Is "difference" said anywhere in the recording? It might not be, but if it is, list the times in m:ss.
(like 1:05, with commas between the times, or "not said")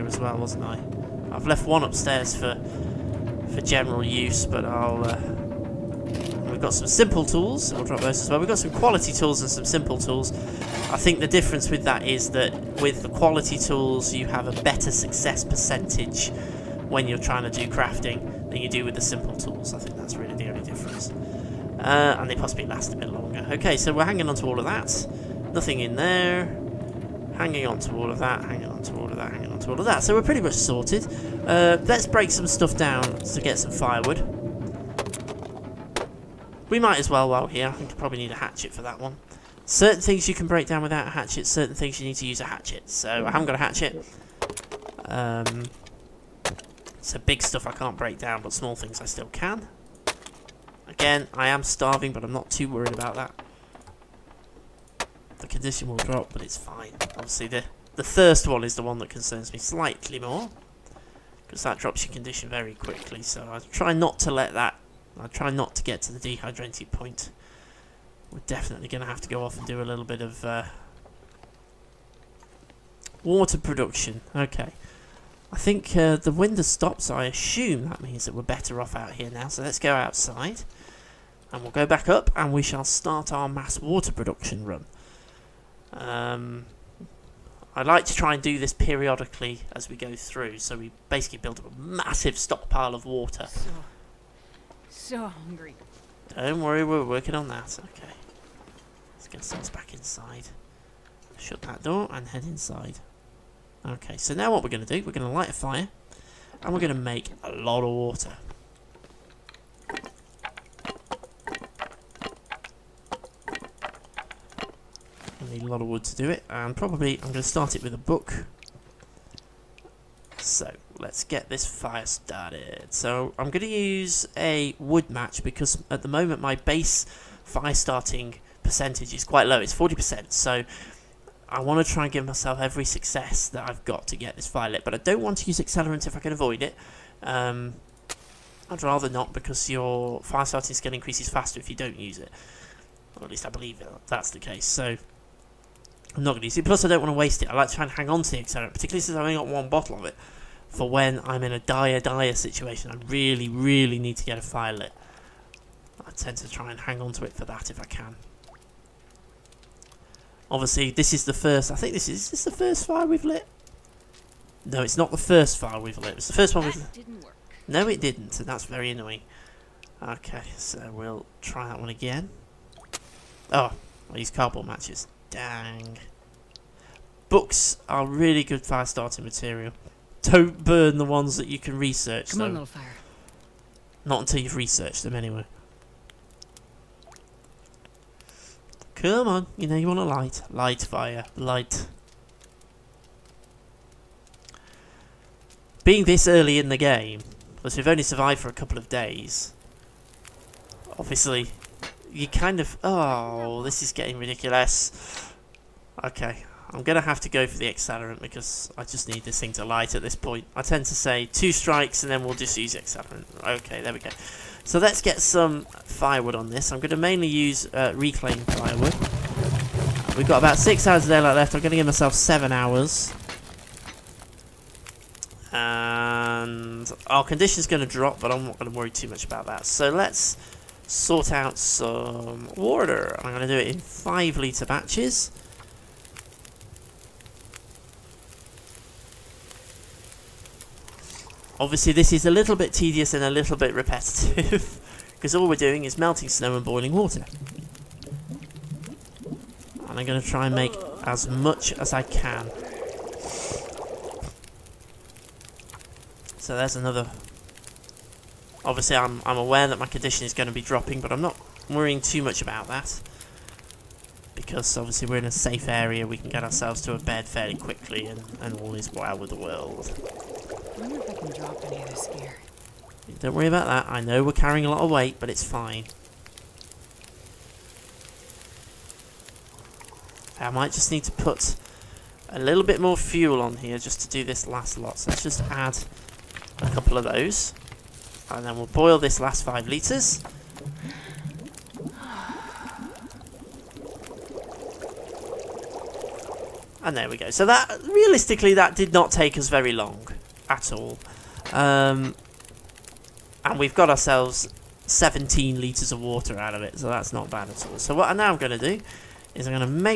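0:11, 0:20.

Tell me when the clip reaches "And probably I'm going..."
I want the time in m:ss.
1:56.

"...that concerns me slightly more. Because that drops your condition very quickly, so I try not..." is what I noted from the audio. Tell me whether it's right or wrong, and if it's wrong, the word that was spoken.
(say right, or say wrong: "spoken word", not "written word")
right.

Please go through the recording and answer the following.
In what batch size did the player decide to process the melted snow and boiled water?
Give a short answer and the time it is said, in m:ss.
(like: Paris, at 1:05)
5 litres, at 3:53.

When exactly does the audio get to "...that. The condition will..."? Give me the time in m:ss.
0:53.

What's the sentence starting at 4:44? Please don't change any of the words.
So let's just add a couple of those.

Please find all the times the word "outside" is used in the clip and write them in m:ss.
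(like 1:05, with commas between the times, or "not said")
1:19.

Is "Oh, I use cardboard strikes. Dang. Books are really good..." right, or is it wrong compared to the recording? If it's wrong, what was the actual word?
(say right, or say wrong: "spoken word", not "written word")
wrong: "matches", not "strikes".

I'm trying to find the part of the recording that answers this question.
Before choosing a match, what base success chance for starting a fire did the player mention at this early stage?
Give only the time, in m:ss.
2:09.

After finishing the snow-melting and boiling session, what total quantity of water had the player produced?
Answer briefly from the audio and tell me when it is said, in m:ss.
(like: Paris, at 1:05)
17 litres, at 5:04.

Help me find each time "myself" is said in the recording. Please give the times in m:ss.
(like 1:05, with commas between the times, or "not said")
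2:12, 3:41.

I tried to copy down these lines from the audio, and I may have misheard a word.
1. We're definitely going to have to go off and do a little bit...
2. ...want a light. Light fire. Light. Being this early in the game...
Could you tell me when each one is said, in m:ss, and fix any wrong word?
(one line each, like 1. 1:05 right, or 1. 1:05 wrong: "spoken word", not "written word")
1. 1:08 right
2. 3:09 right.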